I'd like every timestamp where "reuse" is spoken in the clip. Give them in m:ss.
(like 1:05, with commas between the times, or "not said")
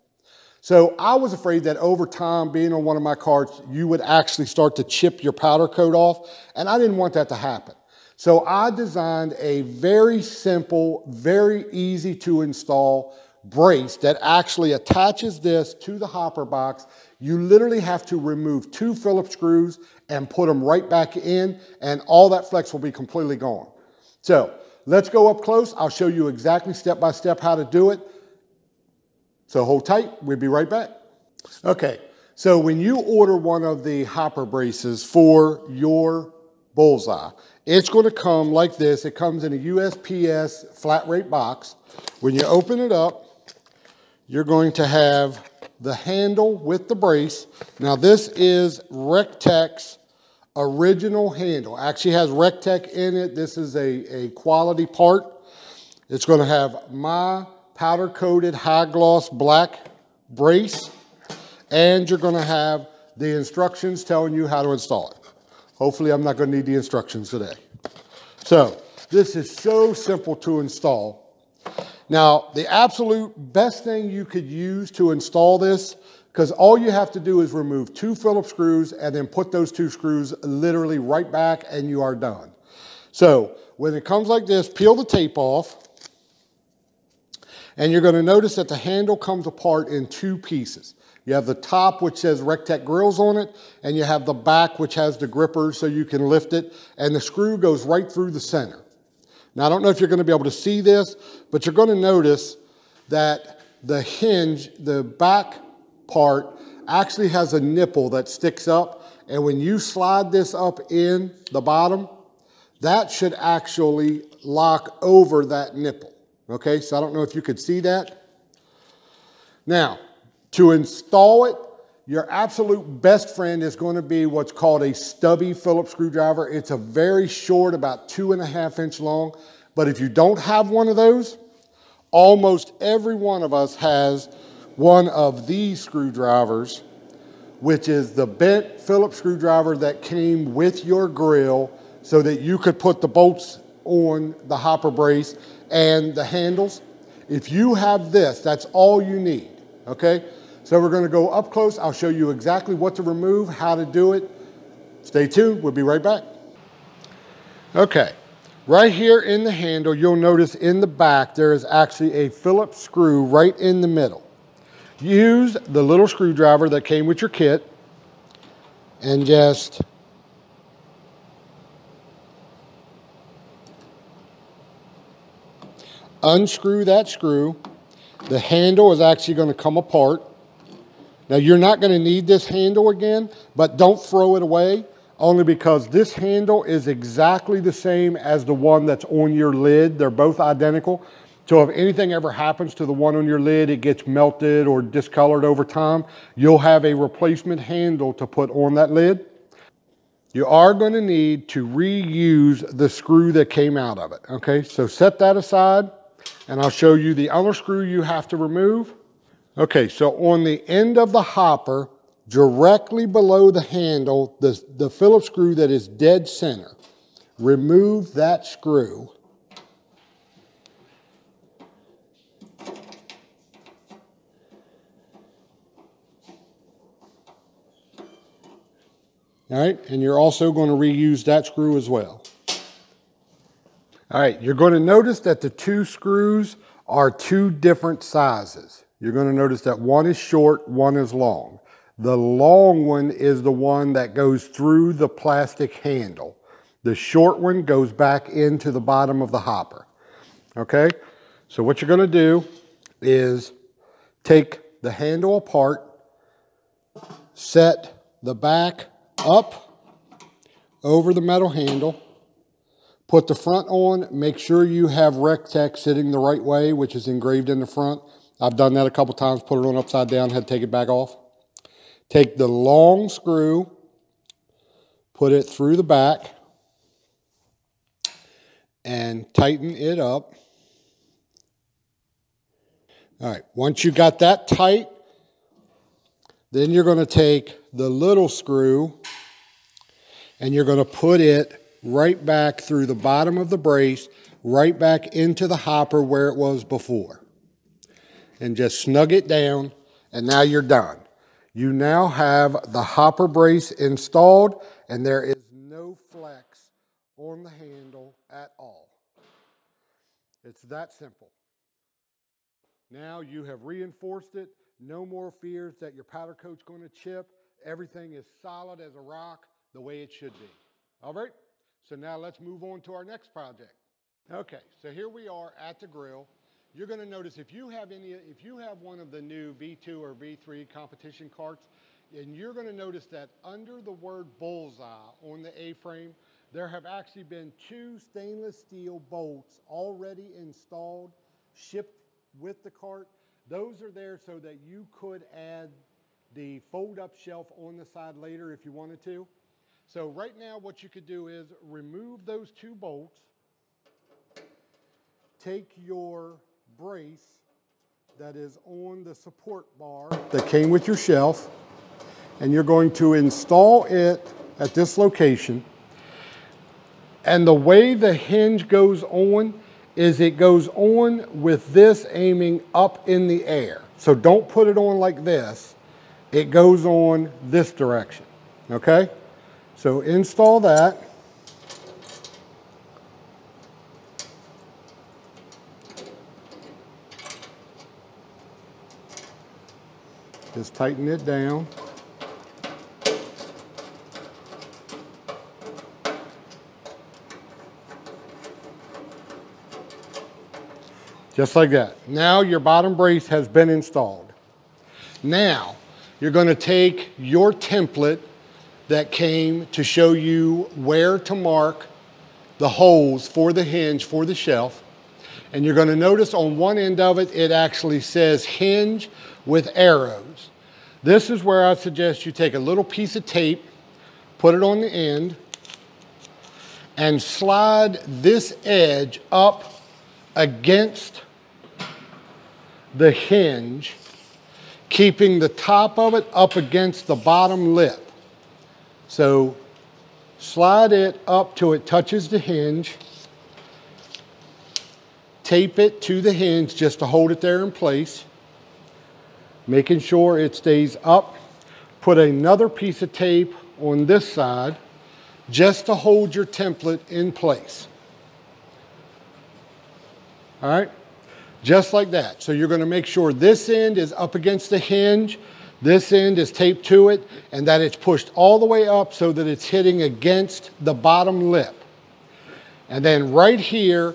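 3:21, 3:50.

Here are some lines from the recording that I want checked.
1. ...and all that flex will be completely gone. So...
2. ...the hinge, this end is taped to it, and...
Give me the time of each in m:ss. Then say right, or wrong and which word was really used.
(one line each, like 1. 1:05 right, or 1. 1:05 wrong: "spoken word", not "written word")
1. 0:21 right
2. 7:44 right.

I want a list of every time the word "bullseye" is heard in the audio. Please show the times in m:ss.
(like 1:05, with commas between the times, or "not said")
0:36, 5:34.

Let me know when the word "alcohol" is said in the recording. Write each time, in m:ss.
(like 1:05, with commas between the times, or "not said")
not said.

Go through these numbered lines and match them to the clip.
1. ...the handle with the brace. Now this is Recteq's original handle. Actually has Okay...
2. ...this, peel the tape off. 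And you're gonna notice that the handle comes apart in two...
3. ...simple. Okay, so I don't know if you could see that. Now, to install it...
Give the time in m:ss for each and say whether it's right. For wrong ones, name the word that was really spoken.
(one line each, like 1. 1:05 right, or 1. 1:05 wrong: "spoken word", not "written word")
1. 0:45 wrong: "Recteq", not "Okay"
2. 1:24 right
3. 1:55 wrong: "nipple", not "simple".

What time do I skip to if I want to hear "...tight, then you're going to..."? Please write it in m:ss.
4:44.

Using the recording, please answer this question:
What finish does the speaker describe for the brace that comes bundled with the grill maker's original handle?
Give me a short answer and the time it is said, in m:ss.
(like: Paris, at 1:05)
powder coated high gloss black, at 0:57.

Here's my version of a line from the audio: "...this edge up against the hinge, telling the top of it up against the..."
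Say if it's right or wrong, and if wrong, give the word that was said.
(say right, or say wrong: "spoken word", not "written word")
wrong: "keeping", not "telling".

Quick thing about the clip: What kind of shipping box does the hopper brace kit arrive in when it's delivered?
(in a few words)
USPS flat rate box.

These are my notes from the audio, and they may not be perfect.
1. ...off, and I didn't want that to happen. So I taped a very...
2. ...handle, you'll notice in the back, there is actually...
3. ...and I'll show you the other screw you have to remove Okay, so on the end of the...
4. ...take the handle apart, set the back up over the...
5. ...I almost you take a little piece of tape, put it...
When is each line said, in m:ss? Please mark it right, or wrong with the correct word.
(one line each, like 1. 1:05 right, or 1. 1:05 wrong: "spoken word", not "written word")
1. 0:05 wrong: "designed", not "taped"
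2. 2:39 right
3. 3:26 right
4. 4:14 right
5. 7:01 wrong: "suggest", not "almost".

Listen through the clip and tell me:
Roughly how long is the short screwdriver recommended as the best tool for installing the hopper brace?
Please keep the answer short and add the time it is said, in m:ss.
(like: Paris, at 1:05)
2.5 inches, at 2:08.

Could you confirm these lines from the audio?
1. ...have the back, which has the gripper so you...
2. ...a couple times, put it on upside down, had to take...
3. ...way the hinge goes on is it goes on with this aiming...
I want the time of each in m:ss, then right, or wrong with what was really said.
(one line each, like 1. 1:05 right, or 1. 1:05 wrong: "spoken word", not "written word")
1. 1:34 right
2. 4:28 right
3. 6:07 right.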